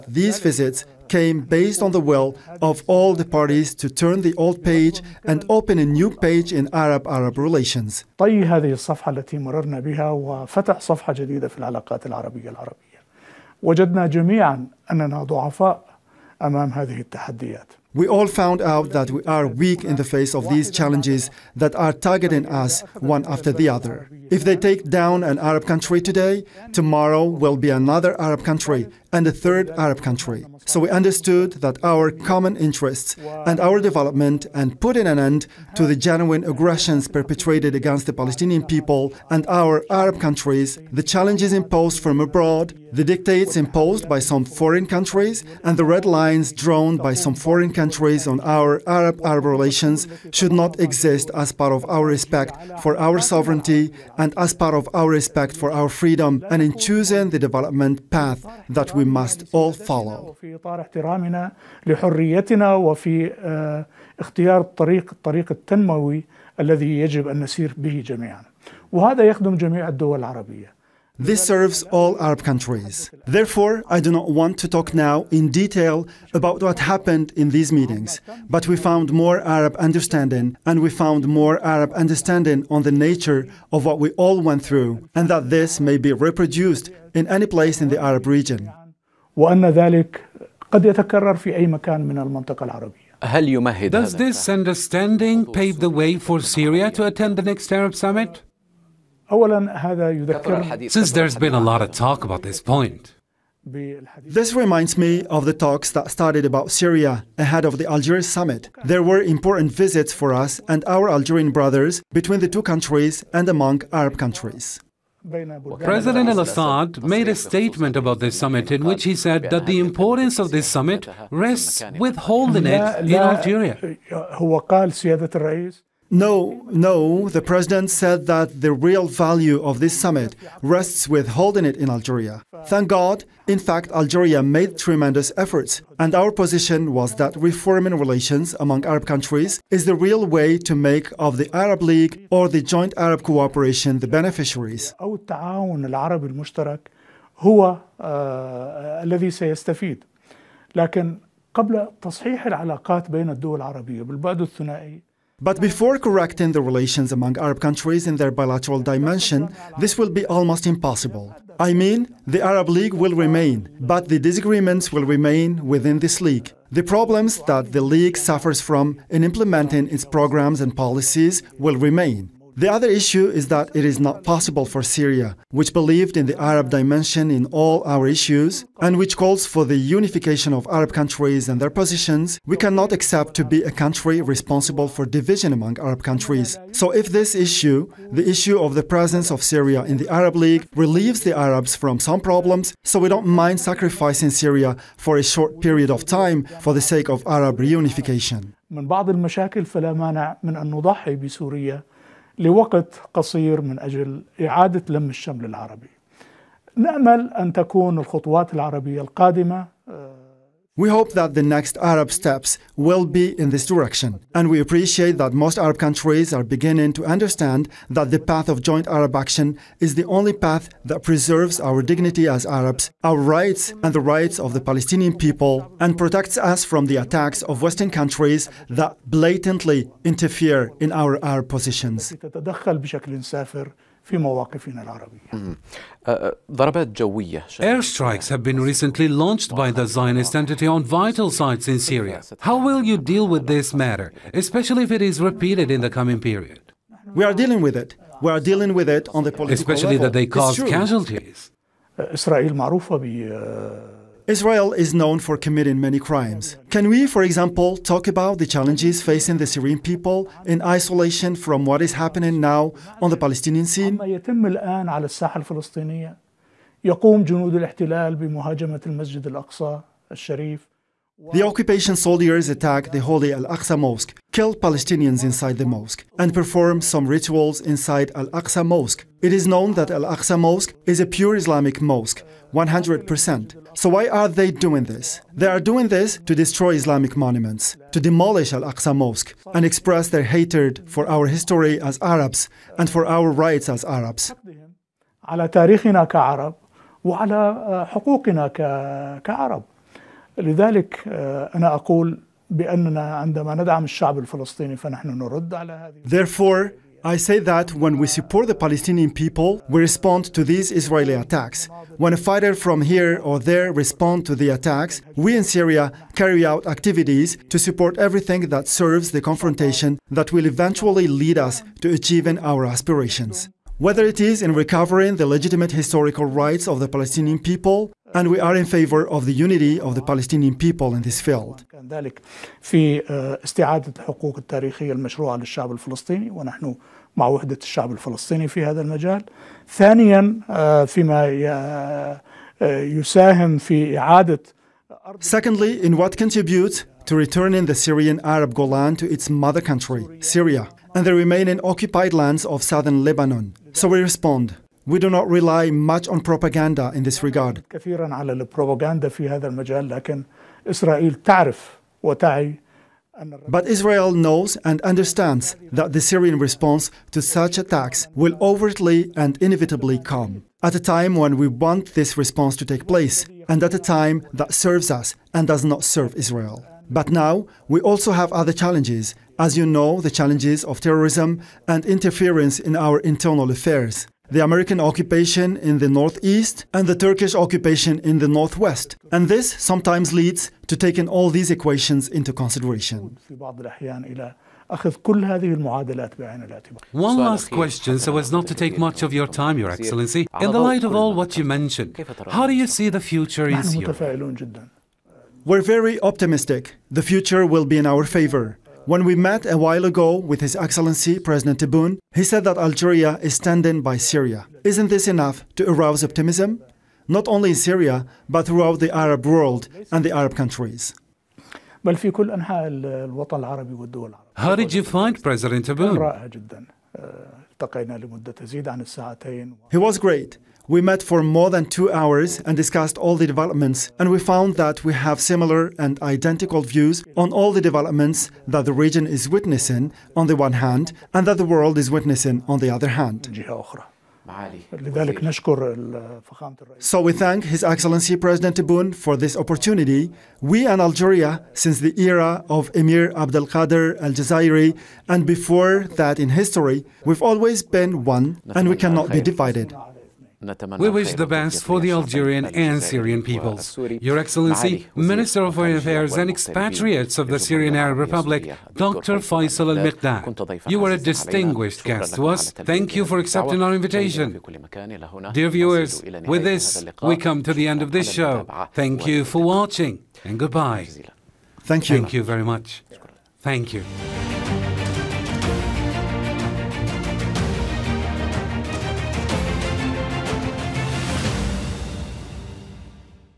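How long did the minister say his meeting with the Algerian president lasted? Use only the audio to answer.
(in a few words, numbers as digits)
more than two hours.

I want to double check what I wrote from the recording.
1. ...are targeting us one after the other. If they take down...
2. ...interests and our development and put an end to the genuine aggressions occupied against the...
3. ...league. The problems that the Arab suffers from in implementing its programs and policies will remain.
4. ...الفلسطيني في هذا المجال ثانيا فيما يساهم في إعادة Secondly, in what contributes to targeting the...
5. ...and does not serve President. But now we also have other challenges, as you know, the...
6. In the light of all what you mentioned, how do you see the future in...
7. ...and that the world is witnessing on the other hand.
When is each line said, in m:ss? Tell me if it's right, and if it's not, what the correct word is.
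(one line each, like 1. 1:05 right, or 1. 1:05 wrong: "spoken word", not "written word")
1. 0:21 right
2. 0:32 wrong: "perpetrated", not "occupied"
3. 2:46 wrong: "League", not "Arab"
4. 5:37 wrong: "returning", not "targeting"
5. 6:15 wrong: "Israel", not "President"
6. 6:40 right
7. 7:21 right.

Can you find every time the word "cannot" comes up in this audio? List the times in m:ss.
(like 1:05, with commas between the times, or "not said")
3:02, 7:38.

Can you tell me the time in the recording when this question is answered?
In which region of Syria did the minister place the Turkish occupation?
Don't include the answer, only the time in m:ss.
6:28.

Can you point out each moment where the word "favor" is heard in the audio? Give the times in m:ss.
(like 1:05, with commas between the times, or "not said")
5:28, 6:48.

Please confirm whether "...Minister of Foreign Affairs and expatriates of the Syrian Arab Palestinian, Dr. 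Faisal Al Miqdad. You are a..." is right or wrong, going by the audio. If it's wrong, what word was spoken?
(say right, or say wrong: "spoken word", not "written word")
wrong: "Republic", not "Palestinian".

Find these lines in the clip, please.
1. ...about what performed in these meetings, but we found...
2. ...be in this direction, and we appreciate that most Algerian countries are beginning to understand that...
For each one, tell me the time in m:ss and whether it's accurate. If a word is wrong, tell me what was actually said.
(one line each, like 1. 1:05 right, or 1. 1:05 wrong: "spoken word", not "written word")
1. 1:16 wrong: "happened", not "performed"
2. 3:33 wrong: "Arab", not "Algerian".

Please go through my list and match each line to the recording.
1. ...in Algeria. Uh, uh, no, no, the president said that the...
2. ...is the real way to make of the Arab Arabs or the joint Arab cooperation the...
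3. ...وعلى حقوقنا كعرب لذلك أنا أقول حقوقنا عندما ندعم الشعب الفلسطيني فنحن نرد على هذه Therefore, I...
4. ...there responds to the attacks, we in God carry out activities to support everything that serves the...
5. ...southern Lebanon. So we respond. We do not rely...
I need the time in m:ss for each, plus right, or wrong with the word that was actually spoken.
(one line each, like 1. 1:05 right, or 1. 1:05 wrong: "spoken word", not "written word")
1. 2:03 right
2. 2:19 wrong: "League", not "Arabs"
3. 4:57 wrong: "بأننا", not "حقوقنا"
4. 5:13 wrong: "Syria", not "God"
5. 5:52 right.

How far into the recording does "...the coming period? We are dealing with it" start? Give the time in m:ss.
4:05.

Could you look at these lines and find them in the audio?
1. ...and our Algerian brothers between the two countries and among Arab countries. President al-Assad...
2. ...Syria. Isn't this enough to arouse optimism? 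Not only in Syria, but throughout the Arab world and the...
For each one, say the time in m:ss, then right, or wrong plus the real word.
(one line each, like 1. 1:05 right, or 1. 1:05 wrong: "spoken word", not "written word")
1. 1:50 right
2. 6:53 right.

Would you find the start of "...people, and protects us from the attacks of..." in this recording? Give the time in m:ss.
3:45.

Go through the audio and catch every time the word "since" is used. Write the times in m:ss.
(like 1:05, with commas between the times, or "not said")
1:40, 7:31.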